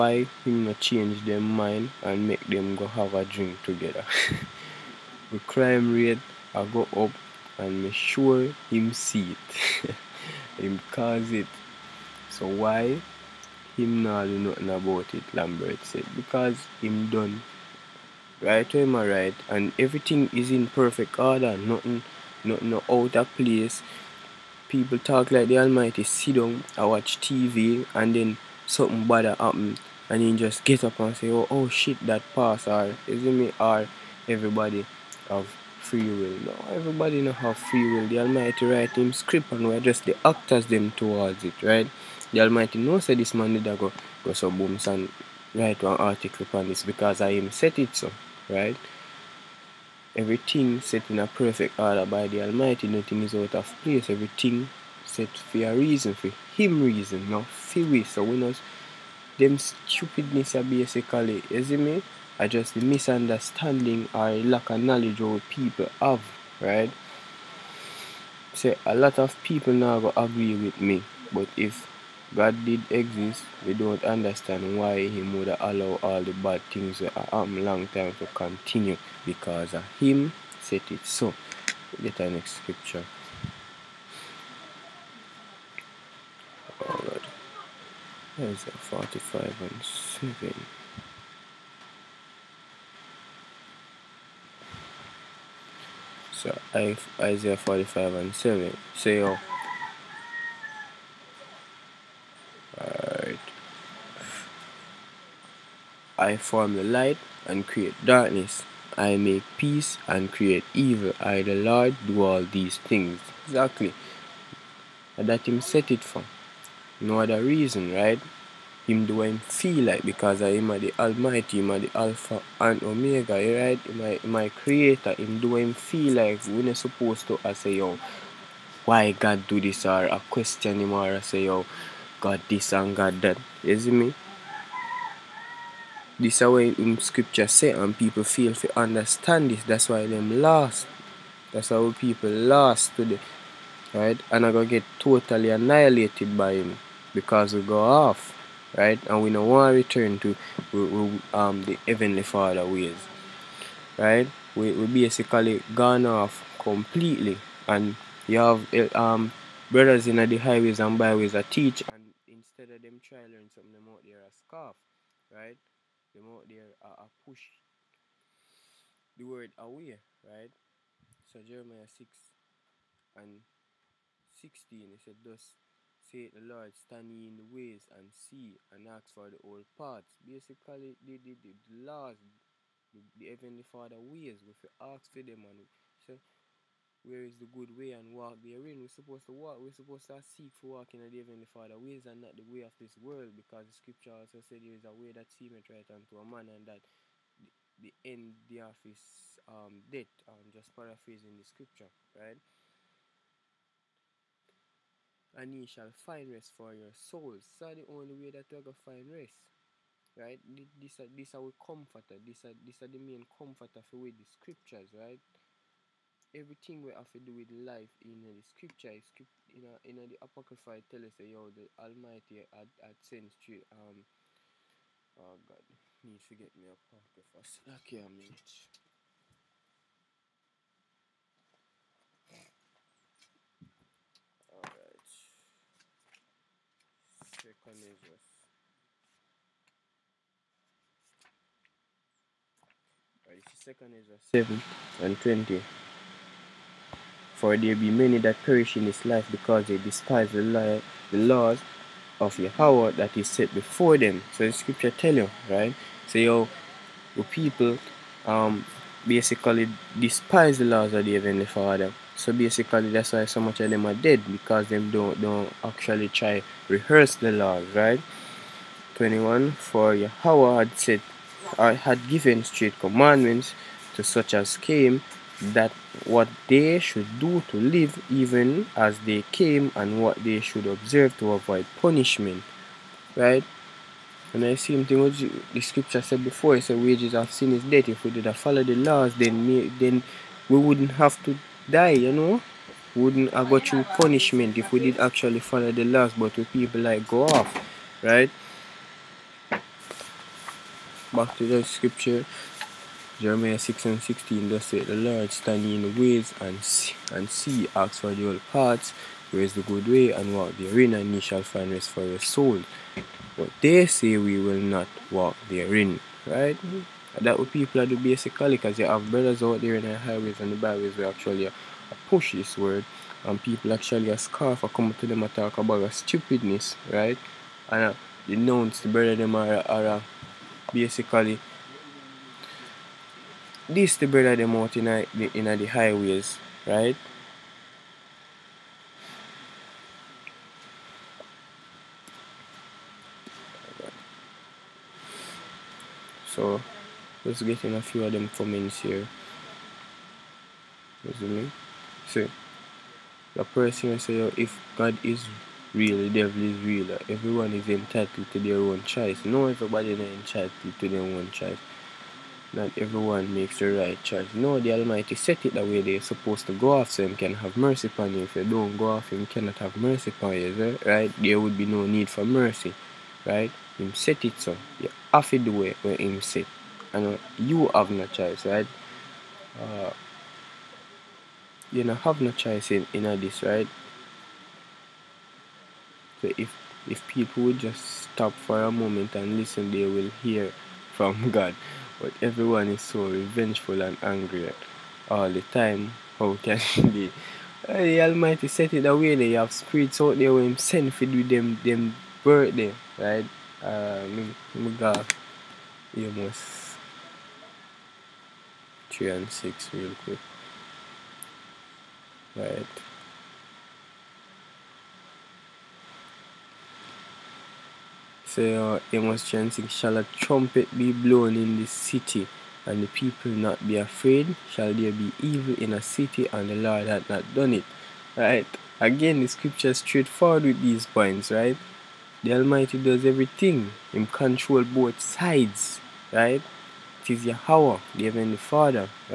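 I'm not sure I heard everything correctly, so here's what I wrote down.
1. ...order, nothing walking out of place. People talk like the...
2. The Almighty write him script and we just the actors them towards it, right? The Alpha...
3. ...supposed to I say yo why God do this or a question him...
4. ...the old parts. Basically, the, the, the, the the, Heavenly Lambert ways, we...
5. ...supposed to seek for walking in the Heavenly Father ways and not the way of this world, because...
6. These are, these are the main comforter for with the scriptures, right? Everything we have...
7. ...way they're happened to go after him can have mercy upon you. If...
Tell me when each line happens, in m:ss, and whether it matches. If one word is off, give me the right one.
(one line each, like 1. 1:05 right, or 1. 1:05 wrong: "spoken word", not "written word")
1. 0:21 wrong: "nothing", not "walking"
2. 0:38 wrong: "Almighty", not "Alpha"
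3. 2:06 right
4. 2:59 wrong: "Father", not "Lambert"
5. 3:09 right
6. 3:32 right
7. 6:05 wrong: "supposed", not "happened".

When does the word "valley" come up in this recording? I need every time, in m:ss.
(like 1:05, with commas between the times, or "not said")
not said.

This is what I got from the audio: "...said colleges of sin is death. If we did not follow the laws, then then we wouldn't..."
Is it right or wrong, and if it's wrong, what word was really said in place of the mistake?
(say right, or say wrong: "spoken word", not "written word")
wrong: "wages", not "colleges".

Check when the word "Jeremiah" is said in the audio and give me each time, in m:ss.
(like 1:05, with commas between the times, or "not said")
2:51, 5:03.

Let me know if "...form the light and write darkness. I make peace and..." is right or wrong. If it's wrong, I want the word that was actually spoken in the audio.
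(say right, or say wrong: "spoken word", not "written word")
wrong: "create", not "write".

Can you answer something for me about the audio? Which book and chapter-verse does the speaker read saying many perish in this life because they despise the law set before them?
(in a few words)
2 Esdras 7:20.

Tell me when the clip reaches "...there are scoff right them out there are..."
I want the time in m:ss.
2:44.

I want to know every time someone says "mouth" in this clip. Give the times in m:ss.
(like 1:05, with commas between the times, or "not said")
not said.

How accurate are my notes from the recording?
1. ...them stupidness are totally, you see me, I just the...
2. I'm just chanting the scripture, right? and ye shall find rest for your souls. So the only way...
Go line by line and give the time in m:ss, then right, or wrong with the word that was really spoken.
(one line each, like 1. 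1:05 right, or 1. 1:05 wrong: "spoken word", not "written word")
1. 0:59 wrong: "basically", not "totally"
2. 3:20 wrong: "paraphrasing", not "chanting".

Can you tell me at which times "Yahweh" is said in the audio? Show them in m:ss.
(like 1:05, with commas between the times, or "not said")
4:12, 4:29, 7:17.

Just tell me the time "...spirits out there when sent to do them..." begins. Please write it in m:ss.
6:39.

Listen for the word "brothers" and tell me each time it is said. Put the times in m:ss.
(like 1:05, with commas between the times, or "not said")
2:39, 5:19, 5:28, 5:34.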